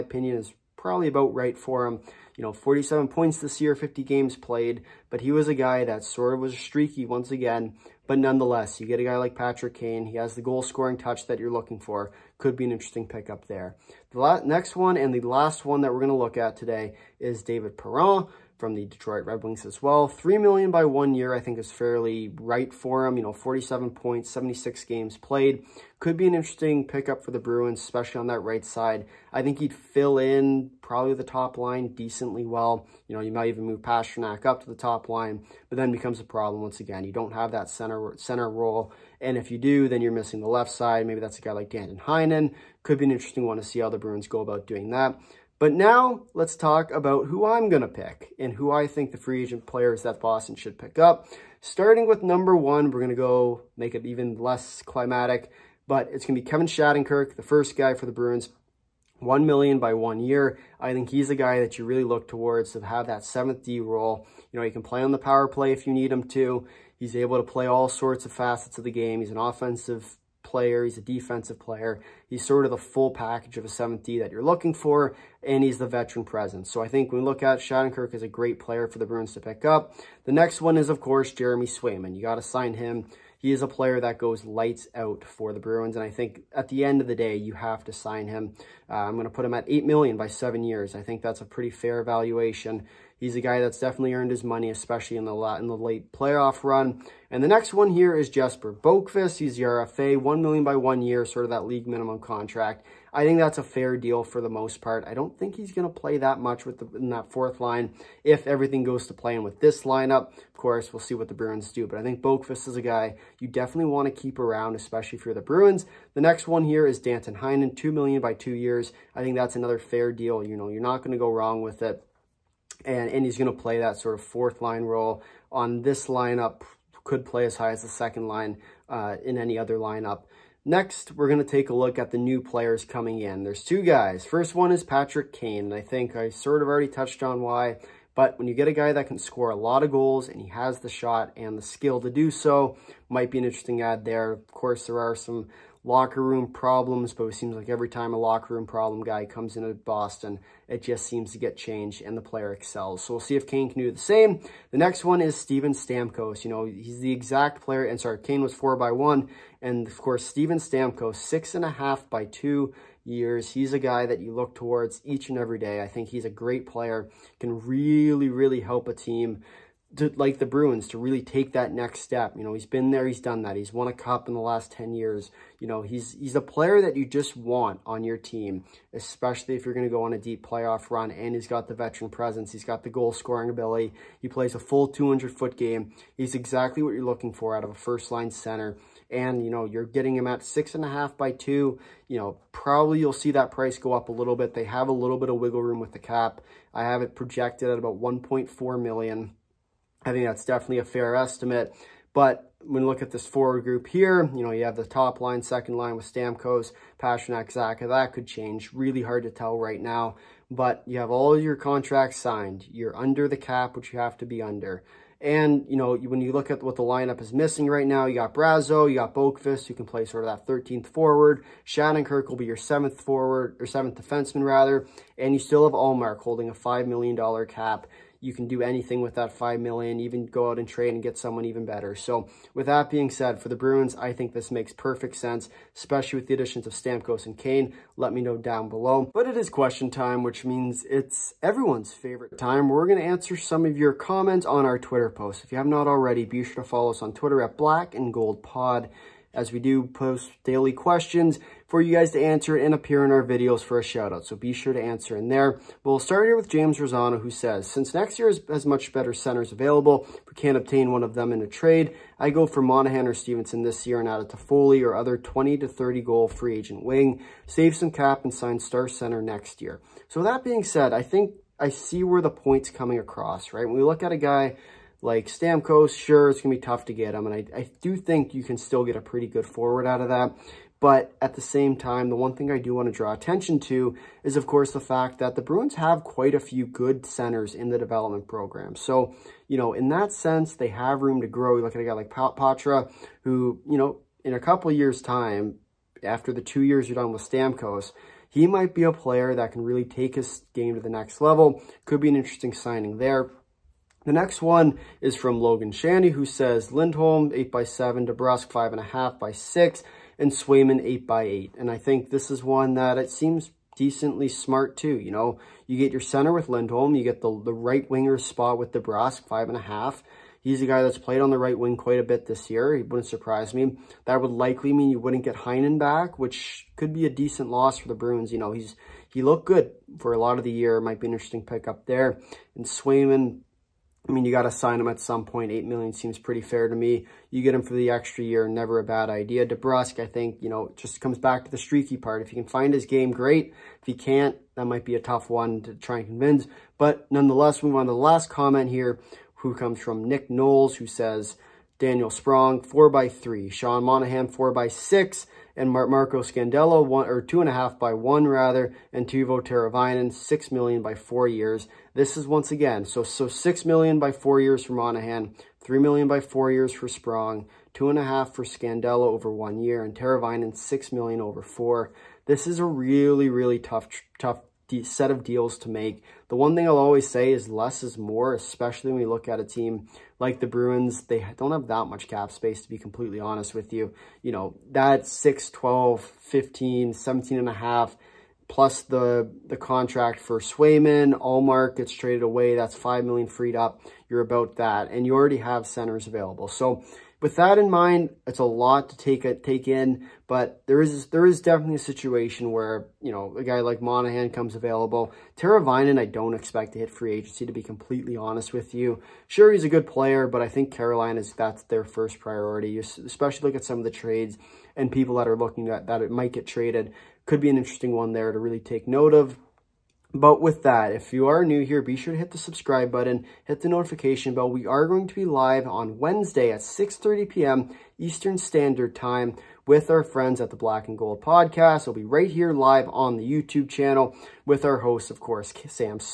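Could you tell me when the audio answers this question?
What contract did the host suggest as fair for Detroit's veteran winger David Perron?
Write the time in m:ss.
0:20.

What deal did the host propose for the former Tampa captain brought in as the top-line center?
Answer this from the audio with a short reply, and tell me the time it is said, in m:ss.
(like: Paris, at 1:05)
6.5 million by 2 years, at 2:41.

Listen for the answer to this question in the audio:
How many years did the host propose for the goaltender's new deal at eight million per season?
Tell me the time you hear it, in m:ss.
1:30.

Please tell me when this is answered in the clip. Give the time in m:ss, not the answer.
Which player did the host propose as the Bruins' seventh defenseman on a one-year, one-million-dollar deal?
0:56.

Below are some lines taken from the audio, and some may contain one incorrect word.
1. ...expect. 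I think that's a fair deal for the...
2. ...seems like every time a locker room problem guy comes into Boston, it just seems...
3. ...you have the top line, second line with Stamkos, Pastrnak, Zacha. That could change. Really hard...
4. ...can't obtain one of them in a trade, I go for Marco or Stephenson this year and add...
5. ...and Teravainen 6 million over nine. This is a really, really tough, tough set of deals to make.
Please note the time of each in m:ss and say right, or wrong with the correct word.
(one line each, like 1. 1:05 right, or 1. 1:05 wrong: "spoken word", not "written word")
1. 1:42 wrong: "contract", not "expect"
2. 2:27 right
3. 3:24 right
4. 4:20 wrong: "Monahan", not "Marco"
5. 6:09 wrong: "four", not "nine".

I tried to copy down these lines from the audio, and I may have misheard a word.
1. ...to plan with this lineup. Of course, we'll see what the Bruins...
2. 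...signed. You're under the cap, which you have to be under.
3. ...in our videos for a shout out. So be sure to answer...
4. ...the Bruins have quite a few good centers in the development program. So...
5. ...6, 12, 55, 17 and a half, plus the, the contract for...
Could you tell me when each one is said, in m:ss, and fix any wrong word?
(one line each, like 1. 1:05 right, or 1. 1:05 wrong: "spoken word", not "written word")
1. 1:49 right
2. 3:32 right
3. 4:13 right
4. 4:45 right
5. 6:25 wrong: "15", not "55".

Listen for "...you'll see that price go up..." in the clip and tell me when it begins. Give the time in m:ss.
3:12.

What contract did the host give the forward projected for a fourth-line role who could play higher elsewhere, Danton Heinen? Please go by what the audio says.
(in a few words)
2 million by 2 years.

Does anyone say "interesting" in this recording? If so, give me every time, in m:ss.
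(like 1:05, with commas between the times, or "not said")
0:12, 0:26, 0:43, 2:23, 5:02, 5:31, 6:57.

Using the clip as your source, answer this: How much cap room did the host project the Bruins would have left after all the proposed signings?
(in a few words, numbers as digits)
1.4 million.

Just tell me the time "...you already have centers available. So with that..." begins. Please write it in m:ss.
6:35.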